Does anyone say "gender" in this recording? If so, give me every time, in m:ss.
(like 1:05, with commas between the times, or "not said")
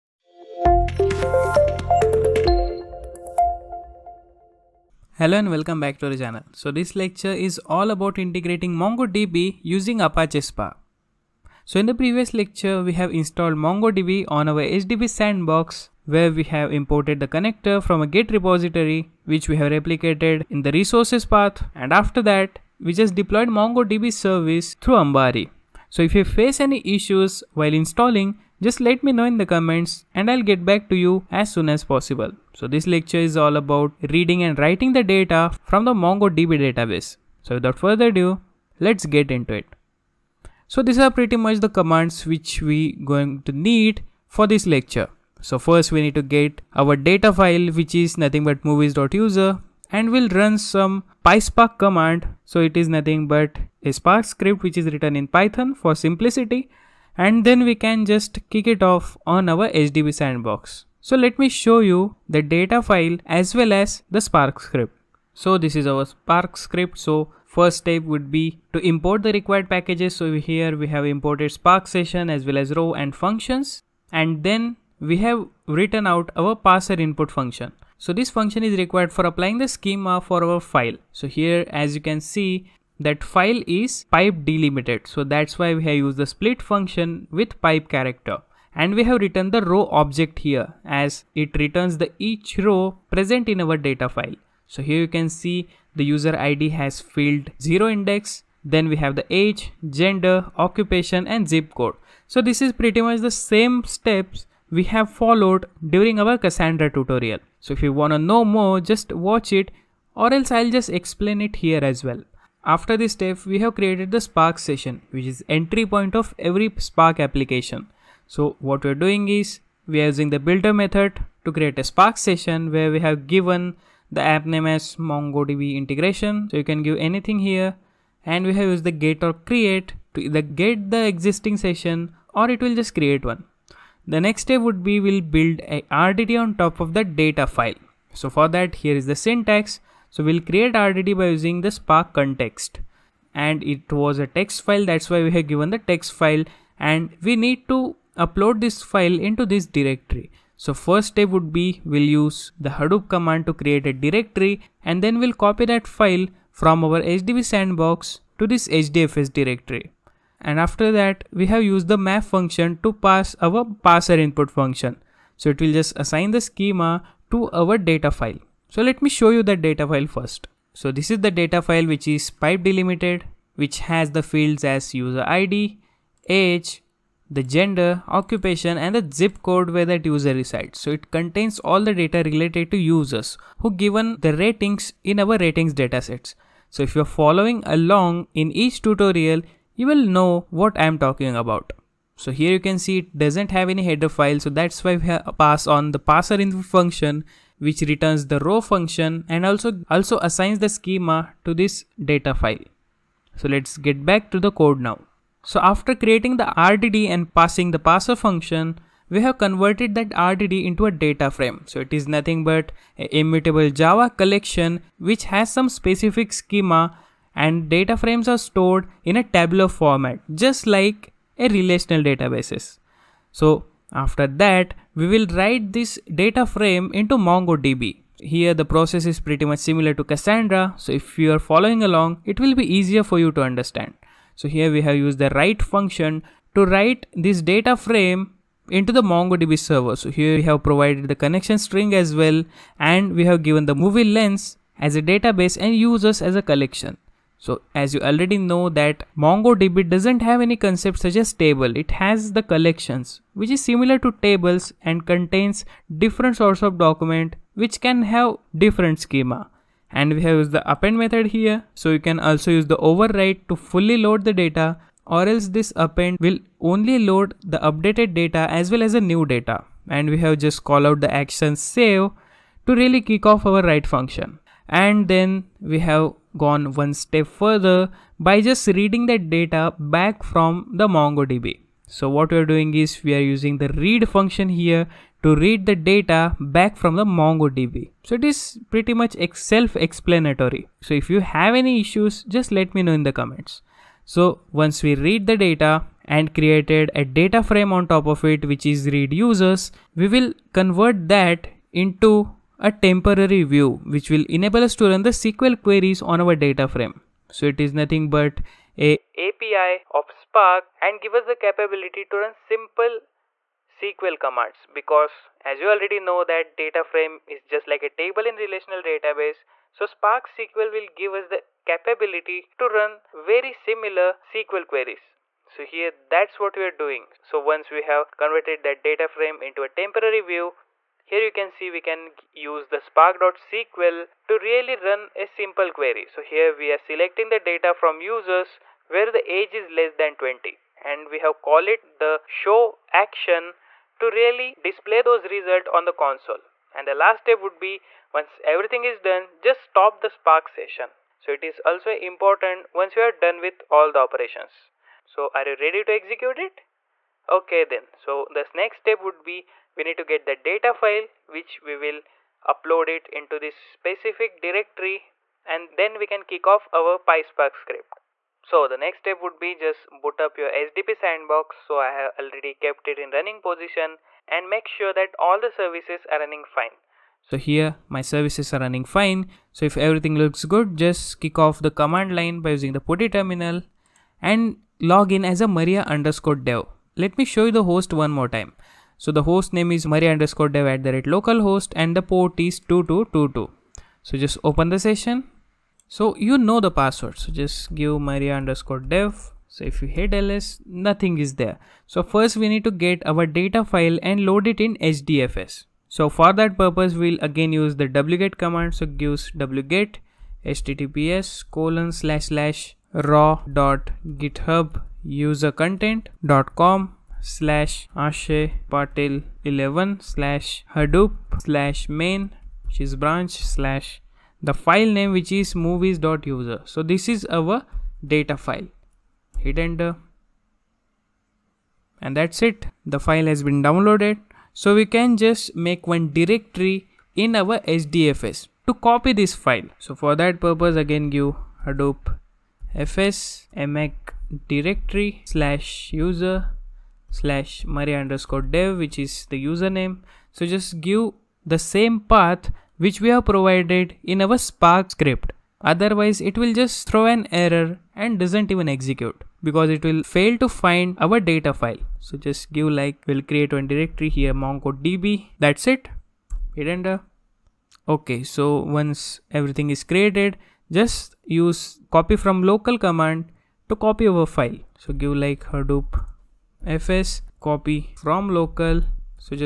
1:39, 2:57.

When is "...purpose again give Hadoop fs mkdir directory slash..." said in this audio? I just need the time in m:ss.
7:20.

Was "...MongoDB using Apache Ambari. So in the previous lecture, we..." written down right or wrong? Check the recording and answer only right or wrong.
wrong.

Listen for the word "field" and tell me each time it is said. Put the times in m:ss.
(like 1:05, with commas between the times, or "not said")
1:37, 2:54.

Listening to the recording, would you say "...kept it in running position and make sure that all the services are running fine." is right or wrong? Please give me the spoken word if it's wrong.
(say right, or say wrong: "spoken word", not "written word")
right.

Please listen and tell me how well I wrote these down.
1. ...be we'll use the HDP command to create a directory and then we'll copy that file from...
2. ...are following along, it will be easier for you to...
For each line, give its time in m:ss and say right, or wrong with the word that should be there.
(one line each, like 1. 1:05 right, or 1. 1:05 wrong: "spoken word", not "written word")
1. 2:31 wrong: "Hadoop", not "HDP"
2. 3:51 right.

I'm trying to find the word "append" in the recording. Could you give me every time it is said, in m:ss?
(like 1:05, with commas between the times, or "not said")
4:20, 4:25.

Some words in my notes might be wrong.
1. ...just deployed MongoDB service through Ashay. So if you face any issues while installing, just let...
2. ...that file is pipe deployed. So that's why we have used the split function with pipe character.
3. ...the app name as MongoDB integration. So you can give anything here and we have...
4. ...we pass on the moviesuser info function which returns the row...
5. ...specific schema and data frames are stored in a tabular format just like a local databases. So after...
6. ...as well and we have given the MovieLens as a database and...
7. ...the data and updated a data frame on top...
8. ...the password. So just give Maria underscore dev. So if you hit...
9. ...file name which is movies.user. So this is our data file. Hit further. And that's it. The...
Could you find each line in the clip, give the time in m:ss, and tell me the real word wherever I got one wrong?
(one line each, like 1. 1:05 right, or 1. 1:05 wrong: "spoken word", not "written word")
1. 0:22 wrong: "Ambari", not "Ashay"
2. 1:23 wrong: "delimited", not "deployed"
3. 2:04 right
4. 3:14 wrong: "parser", not "moviesuser"
5. 3:35 wrong: "relational", not "local"
6. 4:01 right
7. 4:55 wrong: "created", not "updated"
8. 6:36 right
9. 7:04 wrong: "enter", not "further".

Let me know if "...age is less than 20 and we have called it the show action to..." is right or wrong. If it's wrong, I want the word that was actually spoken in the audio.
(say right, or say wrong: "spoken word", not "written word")
right.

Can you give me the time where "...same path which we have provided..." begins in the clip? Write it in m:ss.
7:31.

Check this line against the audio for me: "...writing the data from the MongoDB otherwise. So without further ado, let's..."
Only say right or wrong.
wrong.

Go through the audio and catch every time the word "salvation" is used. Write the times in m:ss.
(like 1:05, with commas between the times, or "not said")
not said.